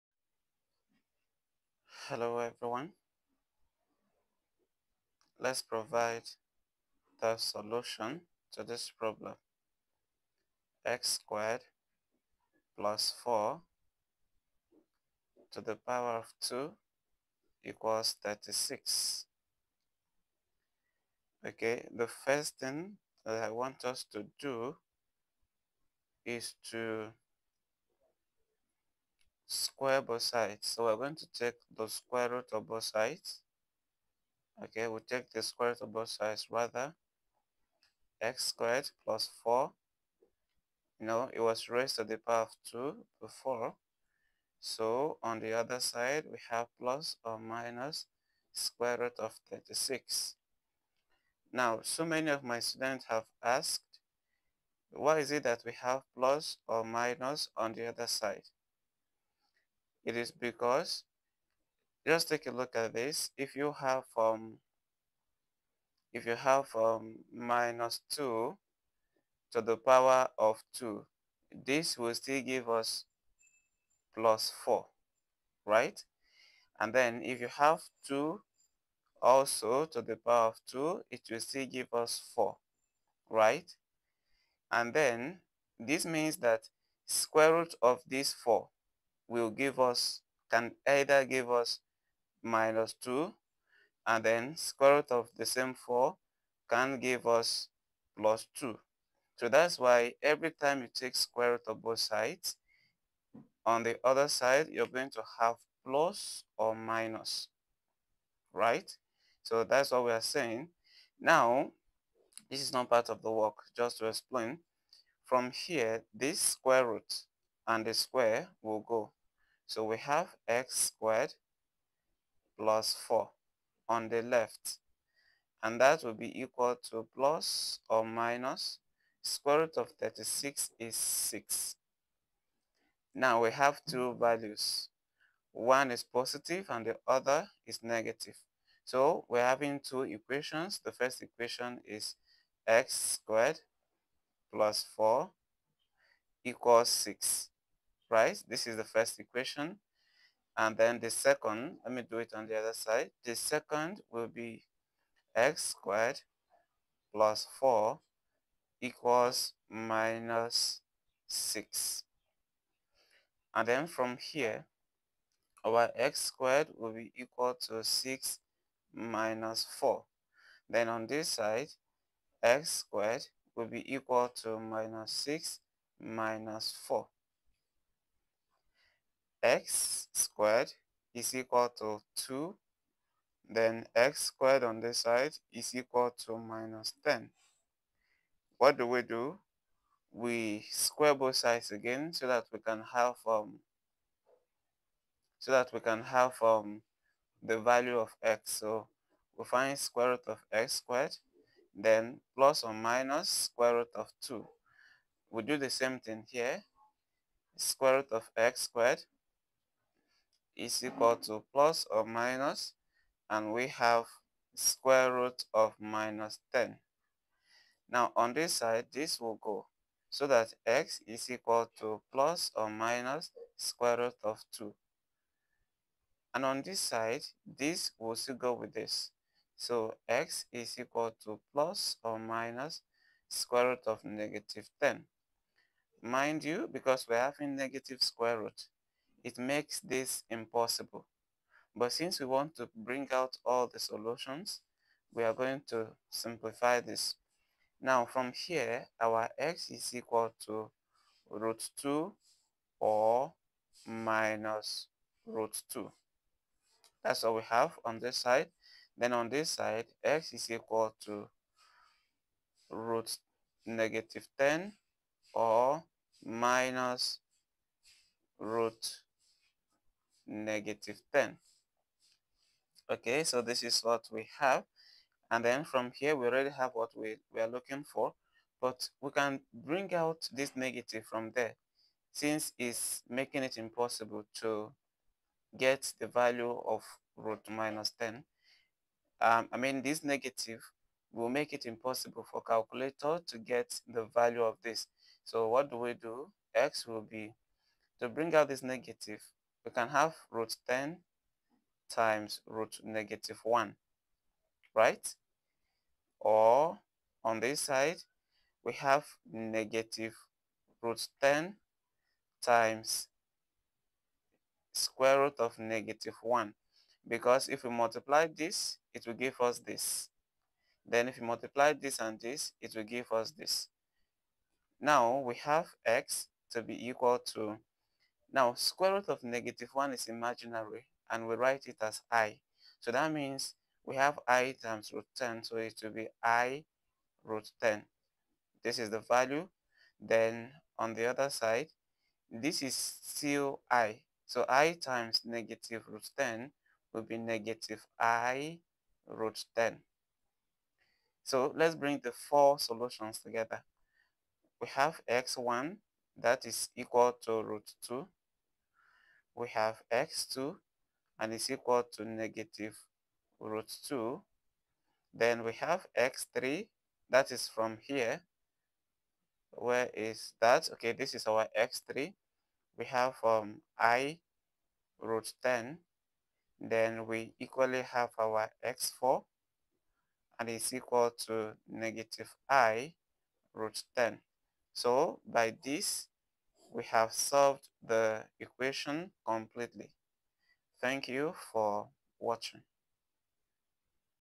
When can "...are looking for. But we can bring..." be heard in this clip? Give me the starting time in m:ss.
4:37.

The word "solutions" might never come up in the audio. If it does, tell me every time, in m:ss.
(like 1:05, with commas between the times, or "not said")
0:07, 4:03, 5:52.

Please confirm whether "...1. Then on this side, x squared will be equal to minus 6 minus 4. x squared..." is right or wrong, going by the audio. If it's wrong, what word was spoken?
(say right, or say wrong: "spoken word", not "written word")
wrong: "4", not "1".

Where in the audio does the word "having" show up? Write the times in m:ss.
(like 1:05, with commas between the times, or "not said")
2:19, 3:57.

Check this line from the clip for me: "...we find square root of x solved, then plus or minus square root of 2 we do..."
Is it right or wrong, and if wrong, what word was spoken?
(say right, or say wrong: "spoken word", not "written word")
wrong: "squared", not "solved".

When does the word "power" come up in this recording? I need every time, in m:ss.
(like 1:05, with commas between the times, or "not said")
0:15, 0:42, 1:09, 1:20.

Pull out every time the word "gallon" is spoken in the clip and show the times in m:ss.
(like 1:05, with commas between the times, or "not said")
not said.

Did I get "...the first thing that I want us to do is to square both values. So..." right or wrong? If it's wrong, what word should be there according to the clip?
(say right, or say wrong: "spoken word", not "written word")
wrong: "sides", not "values".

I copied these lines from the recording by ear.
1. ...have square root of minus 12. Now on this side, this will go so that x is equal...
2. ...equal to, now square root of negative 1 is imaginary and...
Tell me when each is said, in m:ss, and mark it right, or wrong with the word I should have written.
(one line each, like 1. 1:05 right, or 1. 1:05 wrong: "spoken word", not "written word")
1. 3:33 wrong: "10", not "12"
2. 5:26 right.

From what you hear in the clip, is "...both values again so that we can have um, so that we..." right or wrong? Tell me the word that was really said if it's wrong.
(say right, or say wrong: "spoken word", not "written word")
wrong: "sides", not "values".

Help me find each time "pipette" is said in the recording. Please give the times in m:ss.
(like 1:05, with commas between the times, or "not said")
not said.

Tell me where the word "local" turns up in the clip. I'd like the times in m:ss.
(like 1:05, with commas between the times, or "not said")
not said.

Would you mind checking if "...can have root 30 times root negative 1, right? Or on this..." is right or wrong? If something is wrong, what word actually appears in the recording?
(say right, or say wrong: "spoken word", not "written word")
wrong: "10", not "30".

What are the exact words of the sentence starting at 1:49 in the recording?
So that's what we are saying.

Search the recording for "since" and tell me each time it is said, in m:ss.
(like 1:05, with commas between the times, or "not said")
4:01, 4:42.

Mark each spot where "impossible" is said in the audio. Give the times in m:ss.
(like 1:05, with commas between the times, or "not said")
4:00, 4:43, 4:51.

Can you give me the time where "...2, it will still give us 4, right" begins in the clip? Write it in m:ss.
1:20.